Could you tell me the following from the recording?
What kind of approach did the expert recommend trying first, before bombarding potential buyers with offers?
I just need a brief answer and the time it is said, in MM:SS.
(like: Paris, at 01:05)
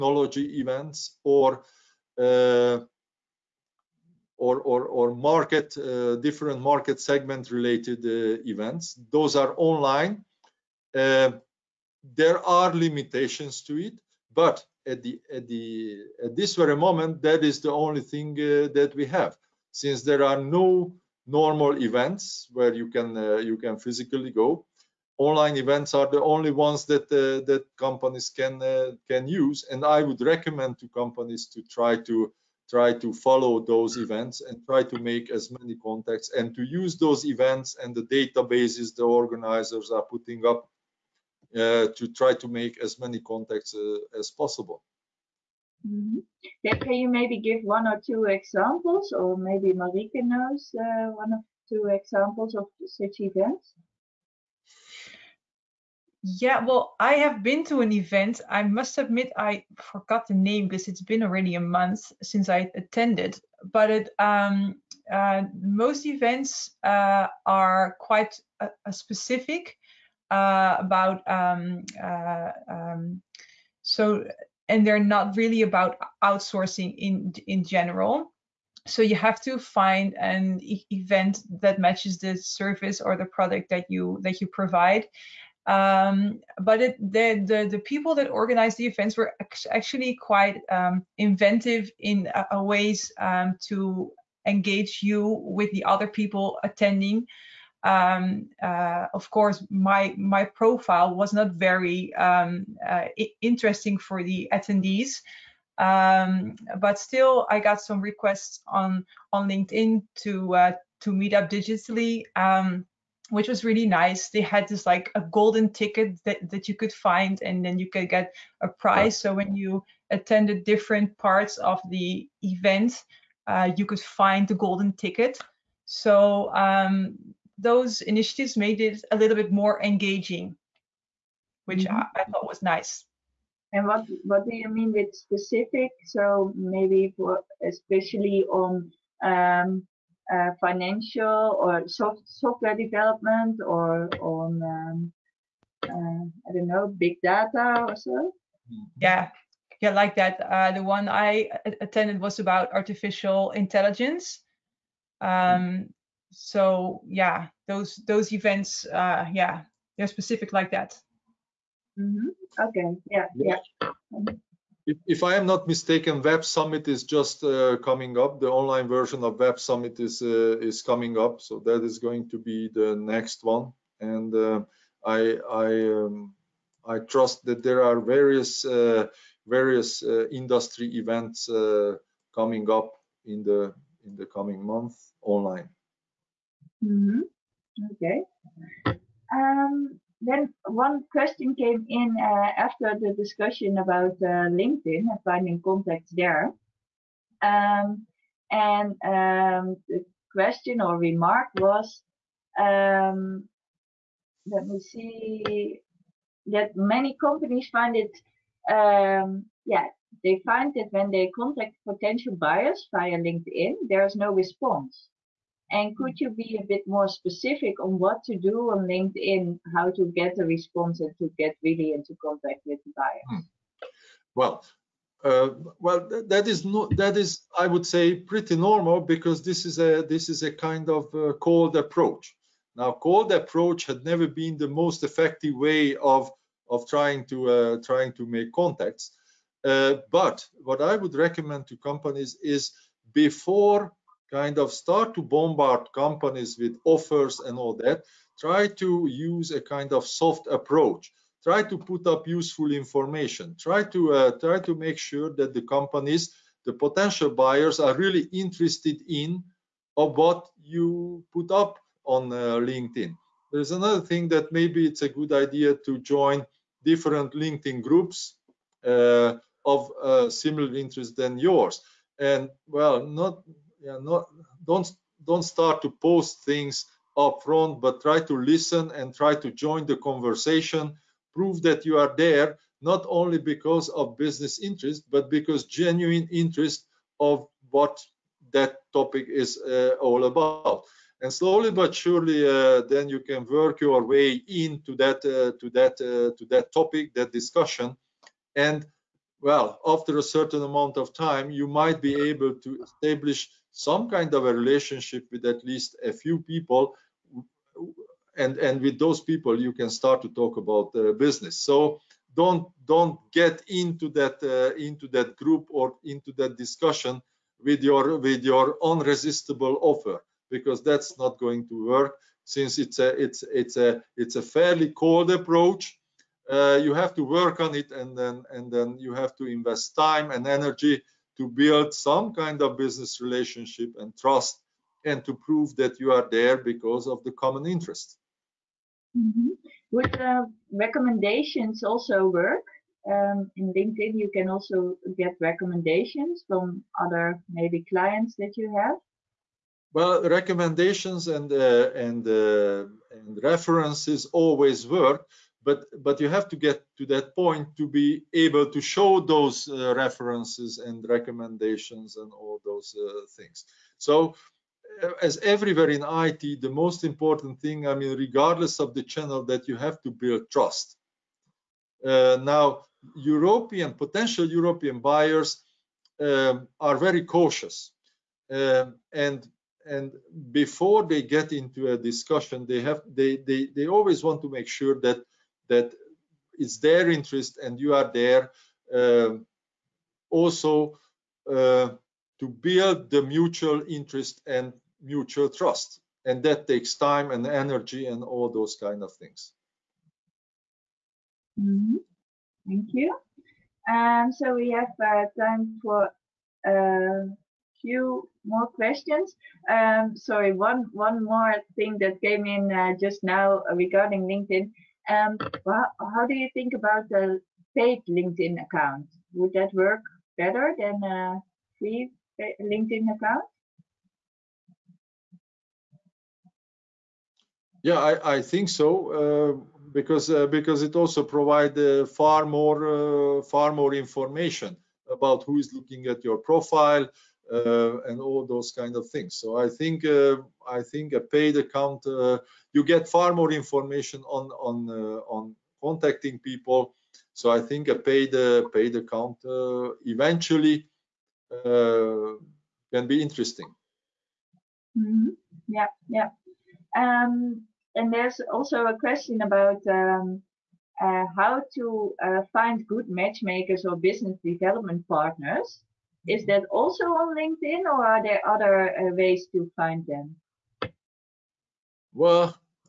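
Soft approach, at 04:10.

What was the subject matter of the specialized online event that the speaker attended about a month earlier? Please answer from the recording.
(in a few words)
Artificial intelligence.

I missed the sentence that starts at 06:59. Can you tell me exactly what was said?
Would that work better than a free LinkedIn account?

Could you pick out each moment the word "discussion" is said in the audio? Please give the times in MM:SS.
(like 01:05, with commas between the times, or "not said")
03:13, 04:57, 05:16, 06:21.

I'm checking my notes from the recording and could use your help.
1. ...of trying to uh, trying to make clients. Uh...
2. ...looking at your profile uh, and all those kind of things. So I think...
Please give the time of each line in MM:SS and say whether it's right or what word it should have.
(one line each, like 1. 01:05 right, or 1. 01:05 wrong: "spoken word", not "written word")
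1. 03:56 wrong: "contacts", not "clients"
2. 07:15 right.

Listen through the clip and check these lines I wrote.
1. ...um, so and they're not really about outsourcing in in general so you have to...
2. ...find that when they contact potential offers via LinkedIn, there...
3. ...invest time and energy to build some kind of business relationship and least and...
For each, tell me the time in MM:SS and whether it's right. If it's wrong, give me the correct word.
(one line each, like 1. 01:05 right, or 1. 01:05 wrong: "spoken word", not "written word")
1. 01:12 right
2. 03:30 wrong: "buyers", not "offers"
3. 05:29 wrong: "trust", not "least".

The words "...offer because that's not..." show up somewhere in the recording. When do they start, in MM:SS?
05:19.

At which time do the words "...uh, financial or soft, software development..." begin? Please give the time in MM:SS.
02:20.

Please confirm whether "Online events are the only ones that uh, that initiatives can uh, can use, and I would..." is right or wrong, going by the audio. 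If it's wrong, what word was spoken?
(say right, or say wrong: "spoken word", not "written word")
wrong: "companies", not "initiatives".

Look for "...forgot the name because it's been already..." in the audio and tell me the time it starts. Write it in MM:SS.
00:59.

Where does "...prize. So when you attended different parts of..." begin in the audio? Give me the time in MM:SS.
01:58.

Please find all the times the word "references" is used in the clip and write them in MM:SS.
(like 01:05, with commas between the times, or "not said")
05:53, 05:59.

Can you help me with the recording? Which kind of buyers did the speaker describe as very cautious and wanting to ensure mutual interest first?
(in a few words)
European buyers.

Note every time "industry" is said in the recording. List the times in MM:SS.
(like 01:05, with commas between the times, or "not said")
03:00.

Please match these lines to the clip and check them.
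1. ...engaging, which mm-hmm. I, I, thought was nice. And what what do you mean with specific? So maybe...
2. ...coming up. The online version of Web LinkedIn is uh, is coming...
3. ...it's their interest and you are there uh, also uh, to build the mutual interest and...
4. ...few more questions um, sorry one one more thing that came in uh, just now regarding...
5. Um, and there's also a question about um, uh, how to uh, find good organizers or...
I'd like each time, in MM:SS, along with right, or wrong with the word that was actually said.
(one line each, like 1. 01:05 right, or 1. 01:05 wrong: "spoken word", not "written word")
1. 02:09 right
2. 02:47 wrong: "Summit", not "LinkedIn"
3. 06:26 right
4. 06:47 right
5. 07:37 wrong: "matchmakers", not "organizers".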